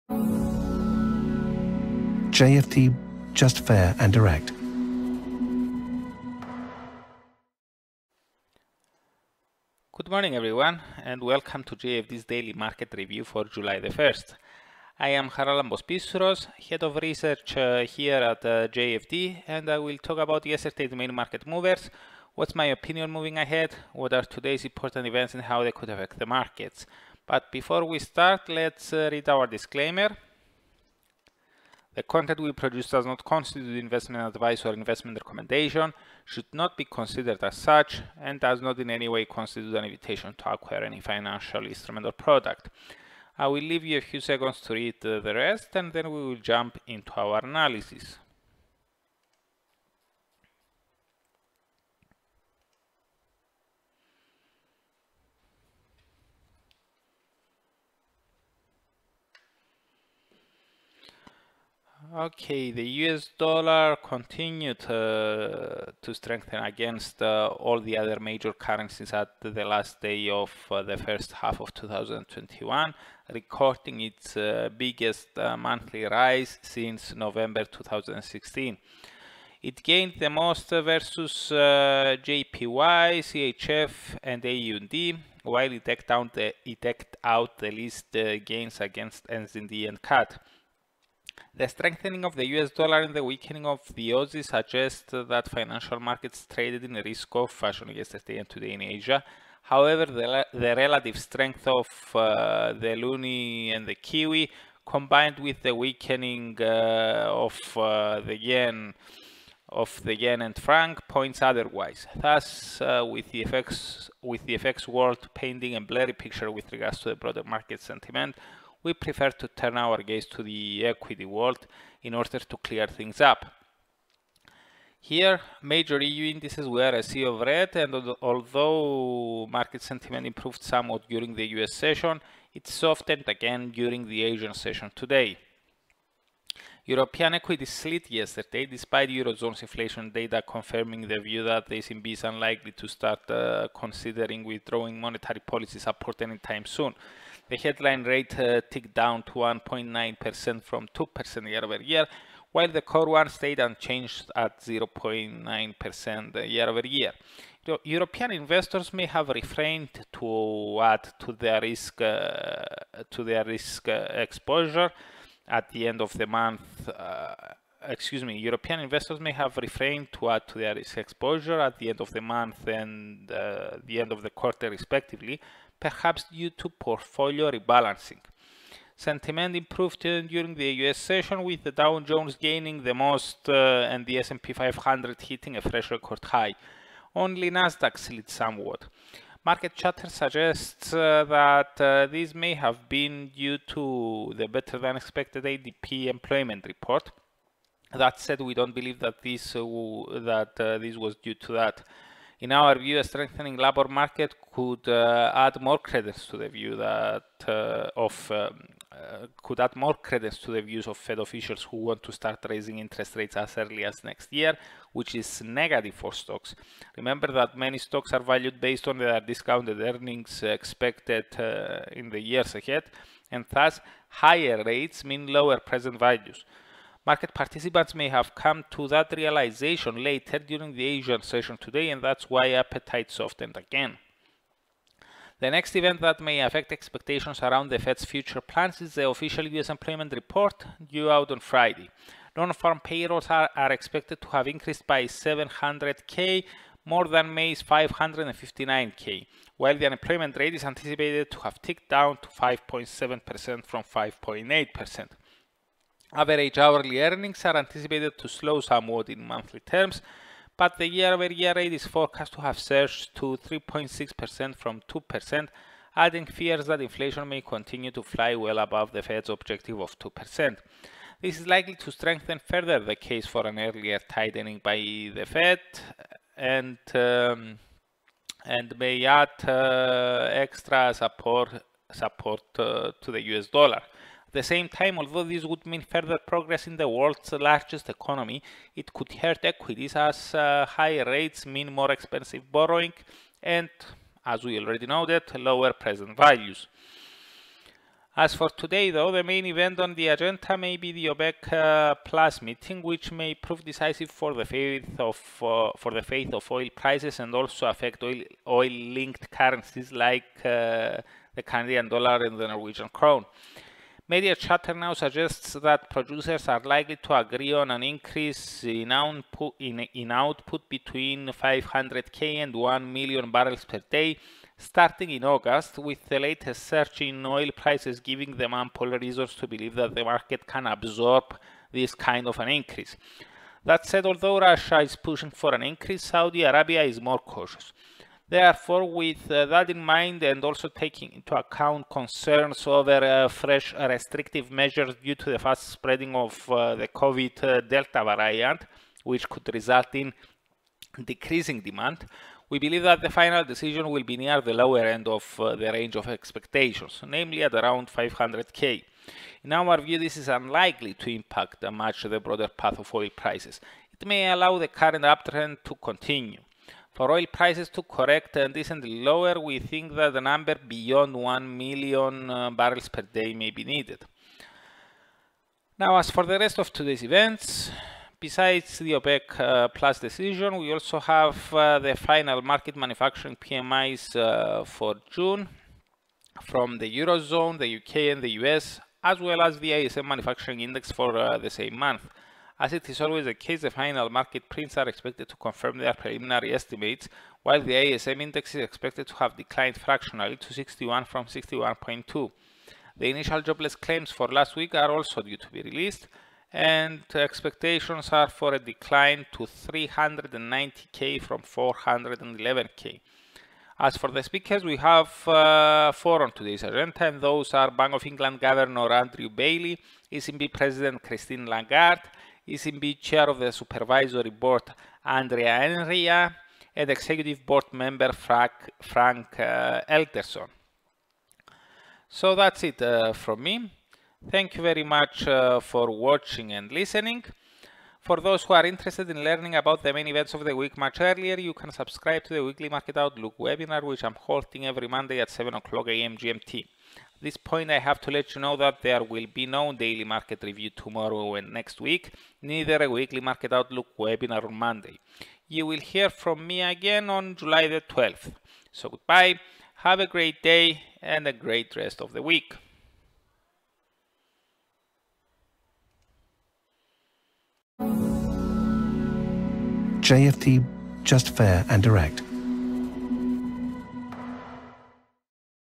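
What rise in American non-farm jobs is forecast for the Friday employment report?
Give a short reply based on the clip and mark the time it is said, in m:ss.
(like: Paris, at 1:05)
700k, at 4:05.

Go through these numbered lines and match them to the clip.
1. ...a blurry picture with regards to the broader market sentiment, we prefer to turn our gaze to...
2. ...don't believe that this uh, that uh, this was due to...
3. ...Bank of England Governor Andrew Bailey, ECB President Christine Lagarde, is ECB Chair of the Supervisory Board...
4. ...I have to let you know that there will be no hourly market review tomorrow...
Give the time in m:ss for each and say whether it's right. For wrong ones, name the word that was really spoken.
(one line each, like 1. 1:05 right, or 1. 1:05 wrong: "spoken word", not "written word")
1. 1:55 right
2. 3:18 right
3. 6:57 right
4. 7:27 wrong: "daily", not "hourly".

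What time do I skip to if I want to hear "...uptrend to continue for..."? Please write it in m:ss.
6:05.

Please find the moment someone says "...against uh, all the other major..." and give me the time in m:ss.
1:06.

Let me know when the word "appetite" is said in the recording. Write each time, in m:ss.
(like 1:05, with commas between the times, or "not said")
3:52.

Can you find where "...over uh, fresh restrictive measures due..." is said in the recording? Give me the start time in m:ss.
5:42.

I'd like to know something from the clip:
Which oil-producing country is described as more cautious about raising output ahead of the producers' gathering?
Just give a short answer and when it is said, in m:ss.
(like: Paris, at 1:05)
Saudi Arabia, at 5:36.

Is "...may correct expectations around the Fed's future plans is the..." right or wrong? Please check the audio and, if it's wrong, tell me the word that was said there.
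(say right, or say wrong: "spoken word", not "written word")
wrong: "affect", not "correct".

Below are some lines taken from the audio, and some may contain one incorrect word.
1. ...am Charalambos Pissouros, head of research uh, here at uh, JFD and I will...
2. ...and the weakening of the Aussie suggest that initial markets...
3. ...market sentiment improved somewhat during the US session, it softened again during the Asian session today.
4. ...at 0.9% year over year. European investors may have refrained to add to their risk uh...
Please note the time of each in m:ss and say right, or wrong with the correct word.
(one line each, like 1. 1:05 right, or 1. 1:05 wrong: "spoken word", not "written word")
1. 0:15 right
2. 1:33 wrong: "financial", not "initial"
3. 2:09 right
4. 2:34 right.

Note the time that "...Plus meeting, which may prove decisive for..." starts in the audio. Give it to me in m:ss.
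5:02.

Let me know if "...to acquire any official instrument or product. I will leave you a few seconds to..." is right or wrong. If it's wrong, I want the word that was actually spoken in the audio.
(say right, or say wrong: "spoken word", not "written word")
wrong: "financial", not "official".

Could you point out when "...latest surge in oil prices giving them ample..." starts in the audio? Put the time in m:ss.
5:26.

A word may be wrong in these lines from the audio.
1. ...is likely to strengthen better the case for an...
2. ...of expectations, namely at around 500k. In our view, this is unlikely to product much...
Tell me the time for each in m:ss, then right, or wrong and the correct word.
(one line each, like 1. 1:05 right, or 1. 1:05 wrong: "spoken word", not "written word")
1. 4:31 wrong: "further", not "better"
2. 5:55 wrong: "impact", not "product".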